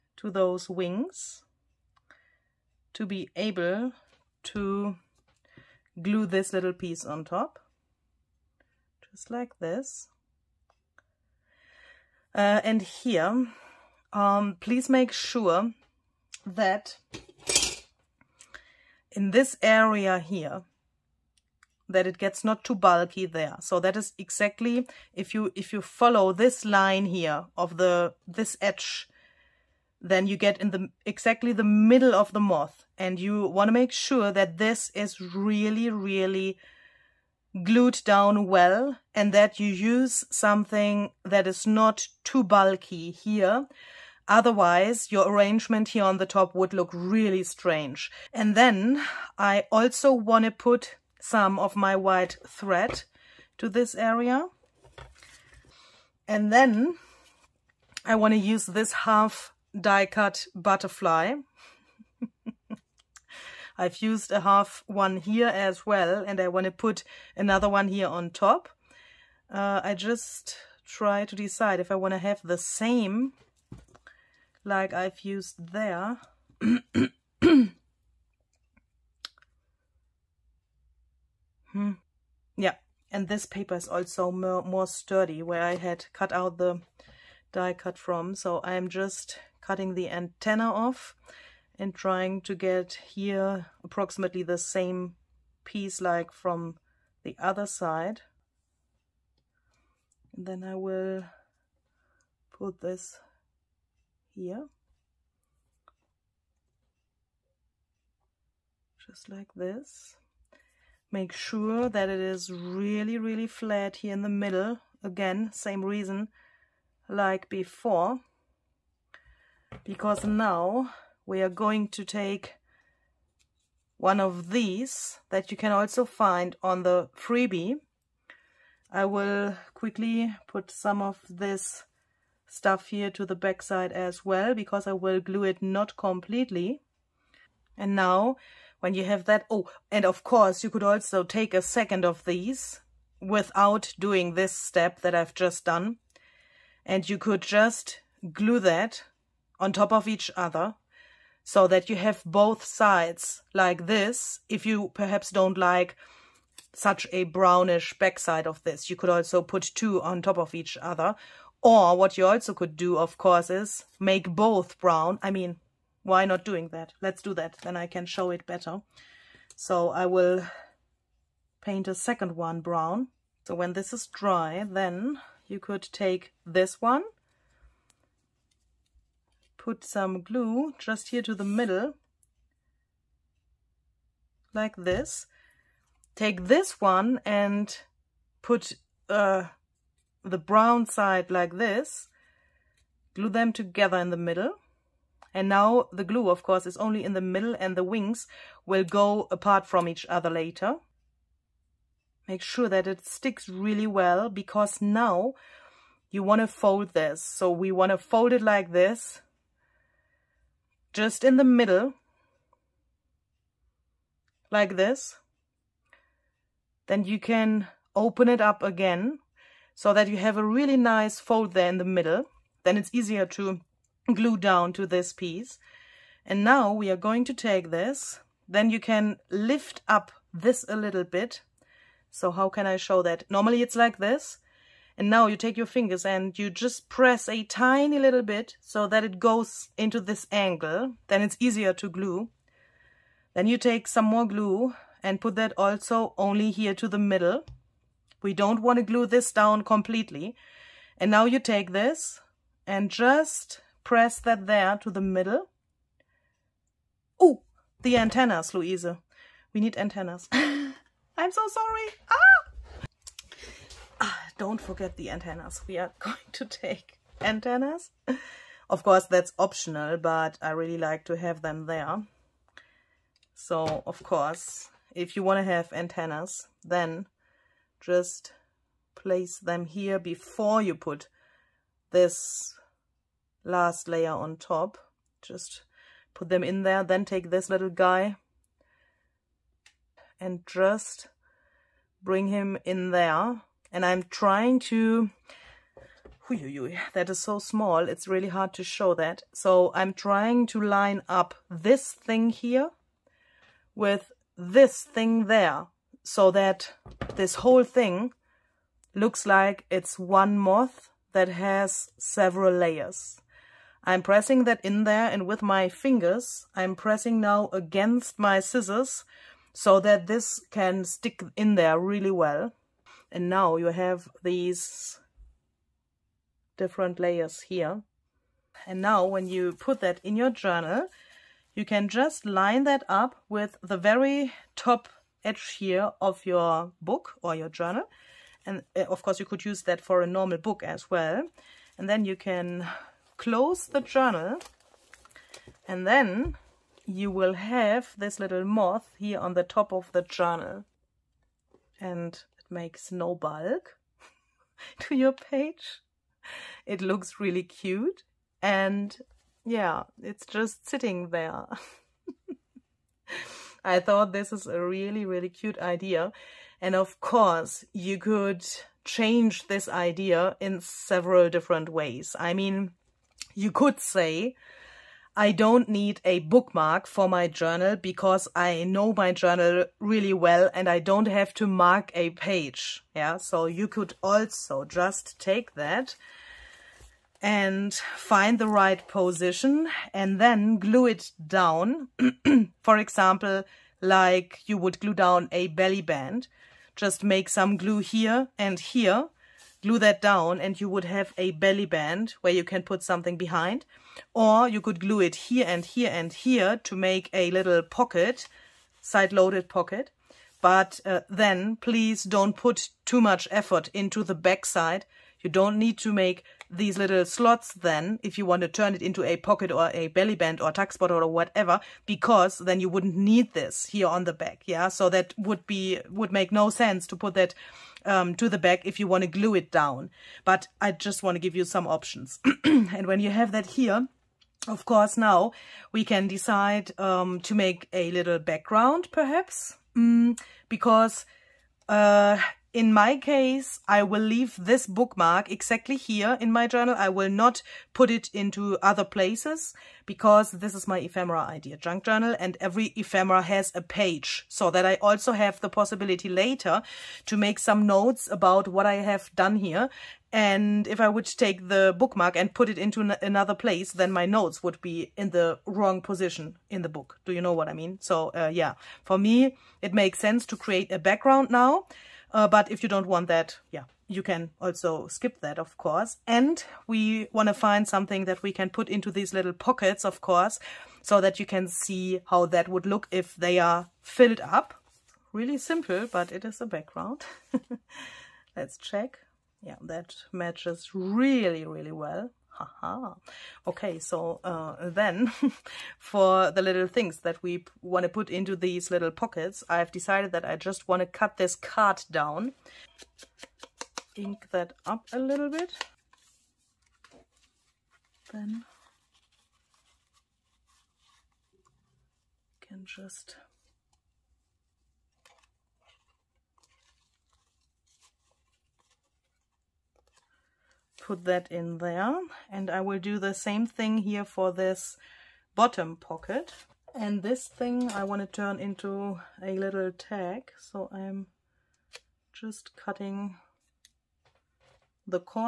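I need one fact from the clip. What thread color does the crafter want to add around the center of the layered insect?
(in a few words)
white.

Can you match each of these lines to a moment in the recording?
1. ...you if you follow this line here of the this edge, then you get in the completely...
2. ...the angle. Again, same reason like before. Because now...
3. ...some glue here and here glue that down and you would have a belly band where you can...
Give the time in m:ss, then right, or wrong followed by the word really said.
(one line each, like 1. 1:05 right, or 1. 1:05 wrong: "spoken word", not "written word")
1. 0:25 wrong: "exactly", not "completely"
2. 1:54 wrong: "middle", not "angle"
3. 6:37 right.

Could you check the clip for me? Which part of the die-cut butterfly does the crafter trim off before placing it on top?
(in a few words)
the antenna.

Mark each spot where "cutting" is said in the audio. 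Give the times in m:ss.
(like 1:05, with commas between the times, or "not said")
1:29, 8:52.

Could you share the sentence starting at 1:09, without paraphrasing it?
Uh, I just try to decide if I want to have the same like I've used there.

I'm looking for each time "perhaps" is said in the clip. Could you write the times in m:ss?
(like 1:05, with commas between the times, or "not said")
2:34, 7:18.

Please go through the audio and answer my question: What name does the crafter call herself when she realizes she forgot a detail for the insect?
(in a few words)
Luise.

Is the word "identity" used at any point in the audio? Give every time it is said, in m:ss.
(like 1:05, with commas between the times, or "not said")
not said.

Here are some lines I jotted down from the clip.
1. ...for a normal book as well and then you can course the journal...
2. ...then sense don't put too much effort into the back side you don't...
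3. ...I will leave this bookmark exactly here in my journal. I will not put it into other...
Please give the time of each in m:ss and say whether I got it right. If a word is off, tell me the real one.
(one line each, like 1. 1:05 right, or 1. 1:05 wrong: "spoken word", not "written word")
1. 5:39 wrong: "close", not "course"
2. 6:51 wrong: "please", not "sense"
3. 7:23 right.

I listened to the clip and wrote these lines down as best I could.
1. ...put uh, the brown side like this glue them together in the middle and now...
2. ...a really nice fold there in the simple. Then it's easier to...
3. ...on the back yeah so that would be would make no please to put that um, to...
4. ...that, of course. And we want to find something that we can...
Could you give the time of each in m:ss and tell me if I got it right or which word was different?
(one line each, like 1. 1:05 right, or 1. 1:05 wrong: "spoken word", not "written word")
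1. 3:08 right
2. 3:40 wrong: "middle", not "simple"
3. 7:03 wrong: "sense", not "please"
4. 7:55 right.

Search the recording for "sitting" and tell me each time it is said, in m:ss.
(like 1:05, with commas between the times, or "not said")
6:00.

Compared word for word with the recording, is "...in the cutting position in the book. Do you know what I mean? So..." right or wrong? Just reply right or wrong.
wrong.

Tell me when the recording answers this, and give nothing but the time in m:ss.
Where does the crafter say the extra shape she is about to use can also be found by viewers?
2:06.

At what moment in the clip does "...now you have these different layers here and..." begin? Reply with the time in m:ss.
5:23.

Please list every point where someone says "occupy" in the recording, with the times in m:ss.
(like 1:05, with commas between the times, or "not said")
not said.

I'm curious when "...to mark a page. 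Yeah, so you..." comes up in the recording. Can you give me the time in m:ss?
6:21.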